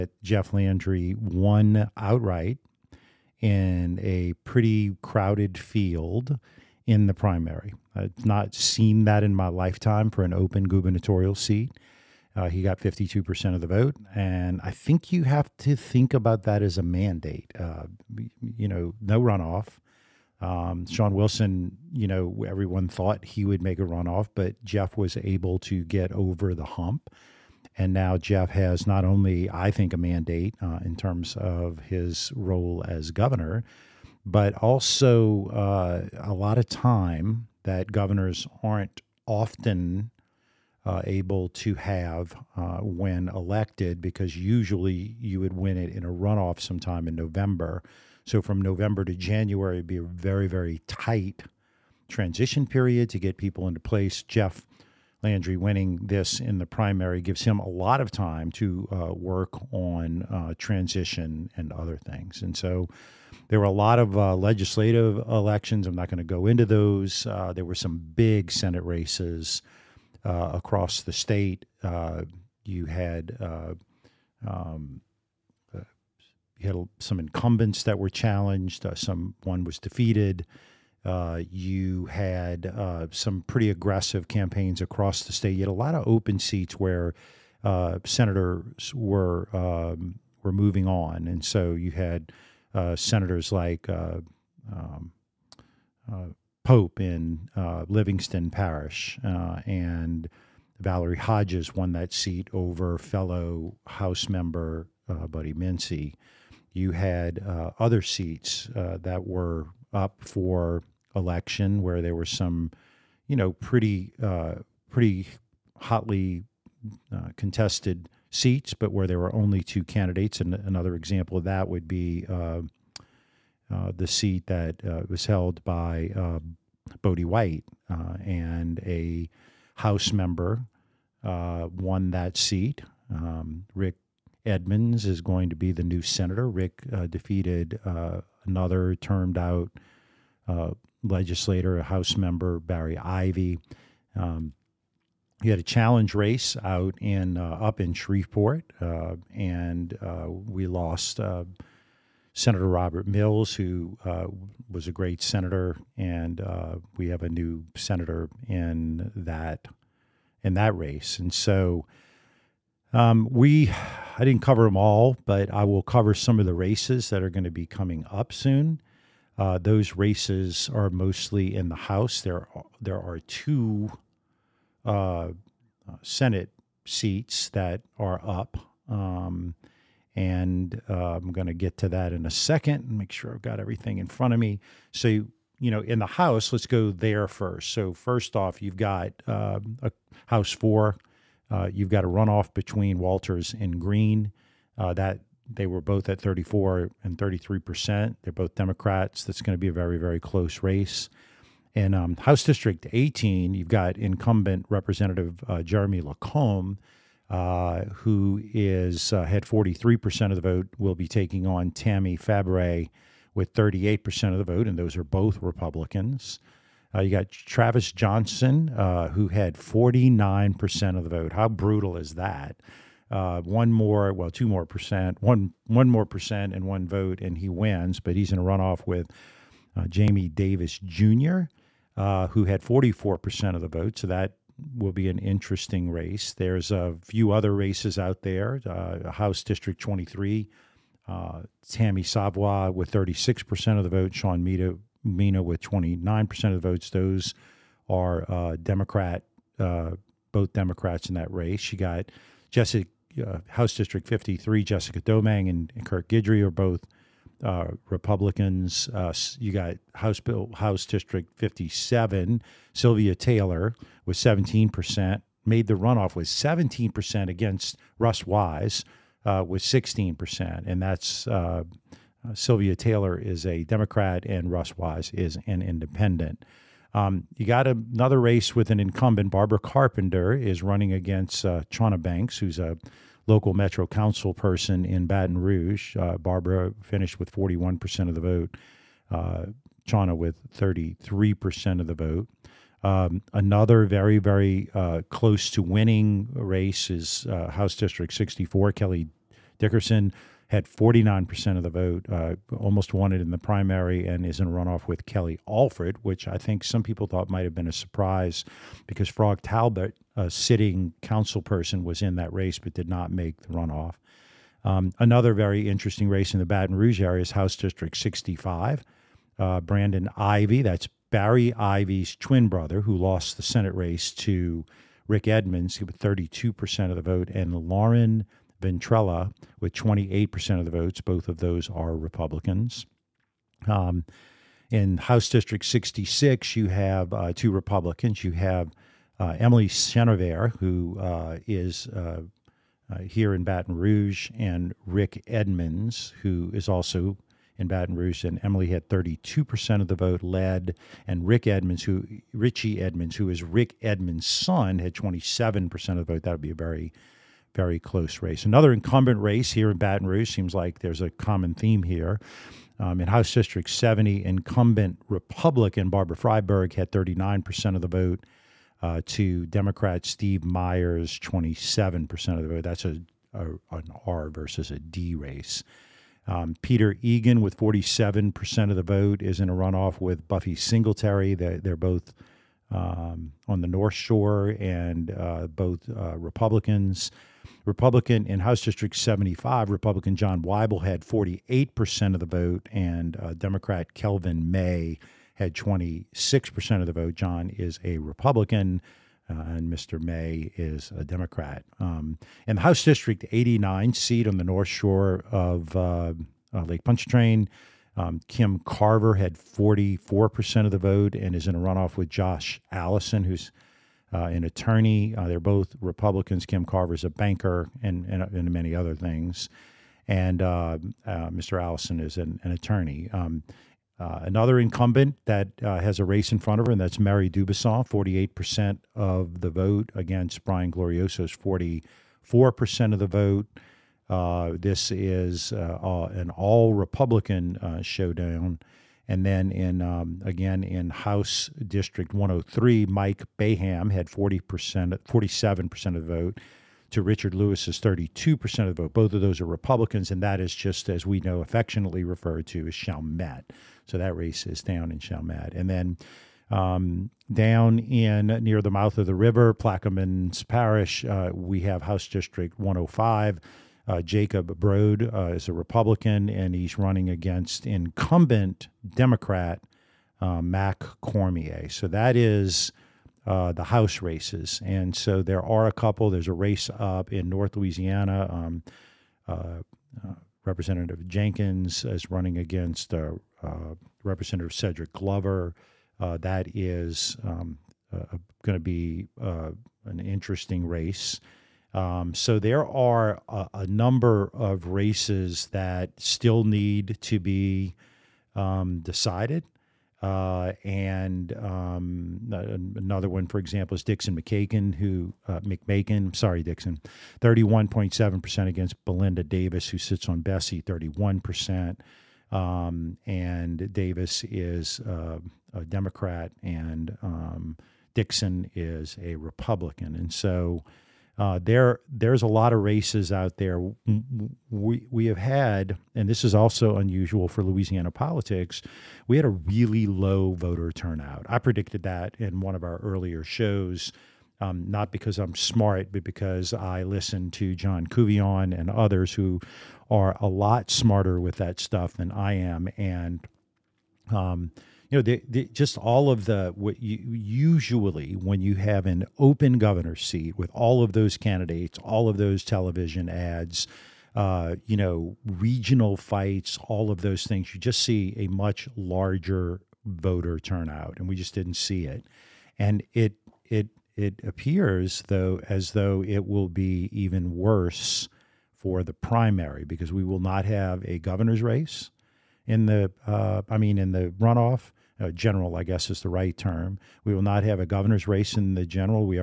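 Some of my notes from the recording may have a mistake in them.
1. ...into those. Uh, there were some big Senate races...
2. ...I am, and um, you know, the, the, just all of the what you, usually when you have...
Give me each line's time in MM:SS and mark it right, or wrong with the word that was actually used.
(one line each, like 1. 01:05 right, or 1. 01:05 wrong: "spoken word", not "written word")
1. 01:06 right
2. 09:02 right.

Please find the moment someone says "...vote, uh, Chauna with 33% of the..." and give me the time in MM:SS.
04:48.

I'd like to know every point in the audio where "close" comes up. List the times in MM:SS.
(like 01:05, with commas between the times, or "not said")
03:20, 04:55, 05:57.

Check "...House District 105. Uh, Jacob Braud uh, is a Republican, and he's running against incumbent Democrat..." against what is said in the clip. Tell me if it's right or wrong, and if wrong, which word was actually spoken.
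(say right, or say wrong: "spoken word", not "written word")
right.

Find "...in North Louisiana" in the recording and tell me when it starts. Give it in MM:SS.
07:57.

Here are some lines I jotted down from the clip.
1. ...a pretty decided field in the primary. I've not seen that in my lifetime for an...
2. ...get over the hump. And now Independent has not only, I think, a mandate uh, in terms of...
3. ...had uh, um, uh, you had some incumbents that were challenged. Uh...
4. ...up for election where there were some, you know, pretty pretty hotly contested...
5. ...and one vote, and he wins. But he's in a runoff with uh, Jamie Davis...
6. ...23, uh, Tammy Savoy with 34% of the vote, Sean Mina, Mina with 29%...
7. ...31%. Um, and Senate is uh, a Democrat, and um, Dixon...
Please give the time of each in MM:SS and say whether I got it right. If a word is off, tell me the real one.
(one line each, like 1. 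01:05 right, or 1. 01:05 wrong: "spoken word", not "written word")
1. 00:04 wrong: "crowded", not "decided"
2. 00:25 wrong: "Jeff", not "Independent"
3. 01:12 right
4. 01:49 right
5. 03:46 right
6. 03:59 wrong: "36", not "34"
7. 08:30 wrong: "Davis", not "Senate".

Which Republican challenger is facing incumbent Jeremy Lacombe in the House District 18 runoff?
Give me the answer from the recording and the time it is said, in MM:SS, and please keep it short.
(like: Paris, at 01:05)
Tammy Fabre, at 03:31.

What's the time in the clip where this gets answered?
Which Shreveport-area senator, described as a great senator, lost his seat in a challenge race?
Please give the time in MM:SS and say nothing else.
02:32.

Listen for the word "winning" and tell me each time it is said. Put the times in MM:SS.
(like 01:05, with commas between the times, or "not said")
00:55, 04:55.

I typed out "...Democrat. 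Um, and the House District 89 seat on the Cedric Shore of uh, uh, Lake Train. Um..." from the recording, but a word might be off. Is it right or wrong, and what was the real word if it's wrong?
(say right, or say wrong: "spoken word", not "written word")
wrong: "North", not "Cedric".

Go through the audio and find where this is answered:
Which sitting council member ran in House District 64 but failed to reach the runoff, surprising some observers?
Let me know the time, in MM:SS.
05:09.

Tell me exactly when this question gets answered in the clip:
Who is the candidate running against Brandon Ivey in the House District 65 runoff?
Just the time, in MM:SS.
05:27.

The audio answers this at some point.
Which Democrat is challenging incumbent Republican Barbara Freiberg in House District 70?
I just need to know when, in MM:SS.
06:10.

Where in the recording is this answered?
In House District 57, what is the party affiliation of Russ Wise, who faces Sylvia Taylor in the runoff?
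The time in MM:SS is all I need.
04:35.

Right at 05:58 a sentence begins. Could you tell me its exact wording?
Another incumbent race here in Baton Rouge seems like there's a common theme here.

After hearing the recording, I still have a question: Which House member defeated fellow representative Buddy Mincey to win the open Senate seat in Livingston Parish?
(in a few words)
Valerie Hodges.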